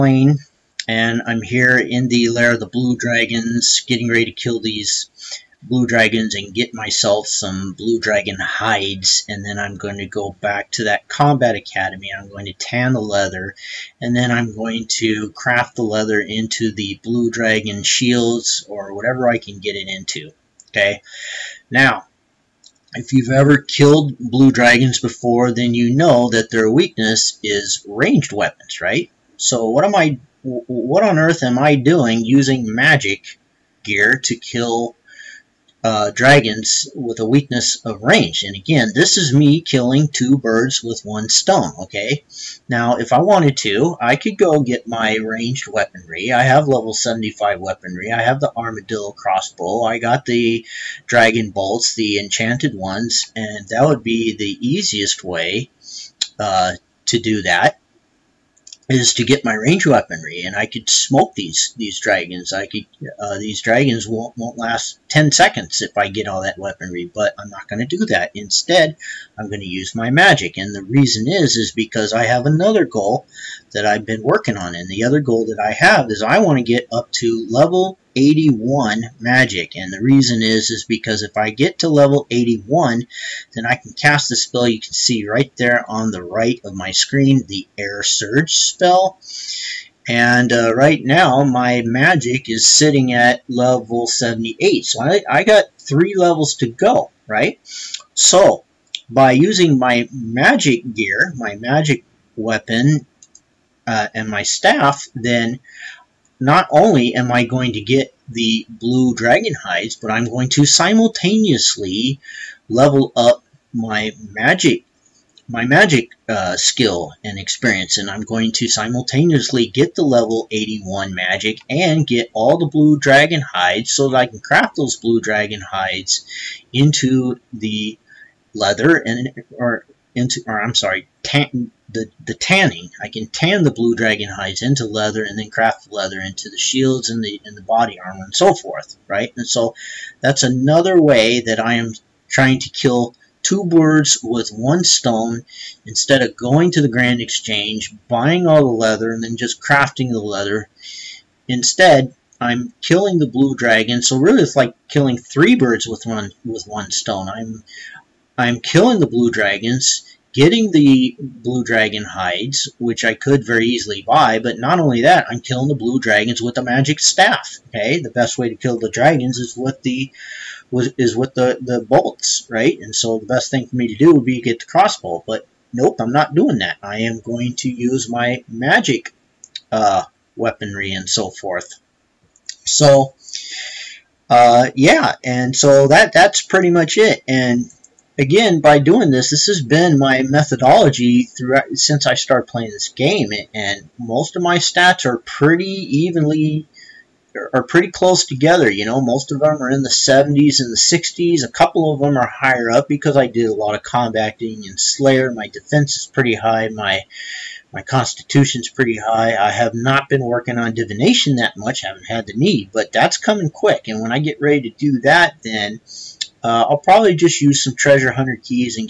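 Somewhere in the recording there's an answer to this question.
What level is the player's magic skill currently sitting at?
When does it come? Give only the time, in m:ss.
1:33.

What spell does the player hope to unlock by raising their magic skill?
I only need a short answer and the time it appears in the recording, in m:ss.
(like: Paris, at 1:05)
Air Surge, at 1:27.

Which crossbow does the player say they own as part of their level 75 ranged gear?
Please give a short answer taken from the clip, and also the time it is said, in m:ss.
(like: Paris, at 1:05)
Armadillo crossbow, at 0:48.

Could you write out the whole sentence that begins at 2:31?
Instead, I'm killing the blue dragon, so really it's like killing three birds with one with one stone.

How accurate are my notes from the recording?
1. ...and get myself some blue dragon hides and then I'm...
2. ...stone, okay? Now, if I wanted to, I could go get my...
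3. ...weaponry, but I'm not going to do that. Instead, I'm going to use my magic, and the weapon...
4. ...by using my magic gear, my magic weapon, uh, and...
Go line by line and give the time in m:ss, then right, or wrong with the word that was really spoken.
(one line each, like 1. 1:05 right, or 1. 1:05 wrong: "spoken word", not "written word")
1. 0:06 right
2. 0:41 right
3. 1:06 wrong: "reason", not "weapon"
4. 1:39 right.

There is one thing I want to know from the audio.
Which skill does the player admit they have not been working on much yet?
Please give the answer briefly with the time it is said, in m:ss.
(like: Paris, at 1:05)
Divination, at 3:30.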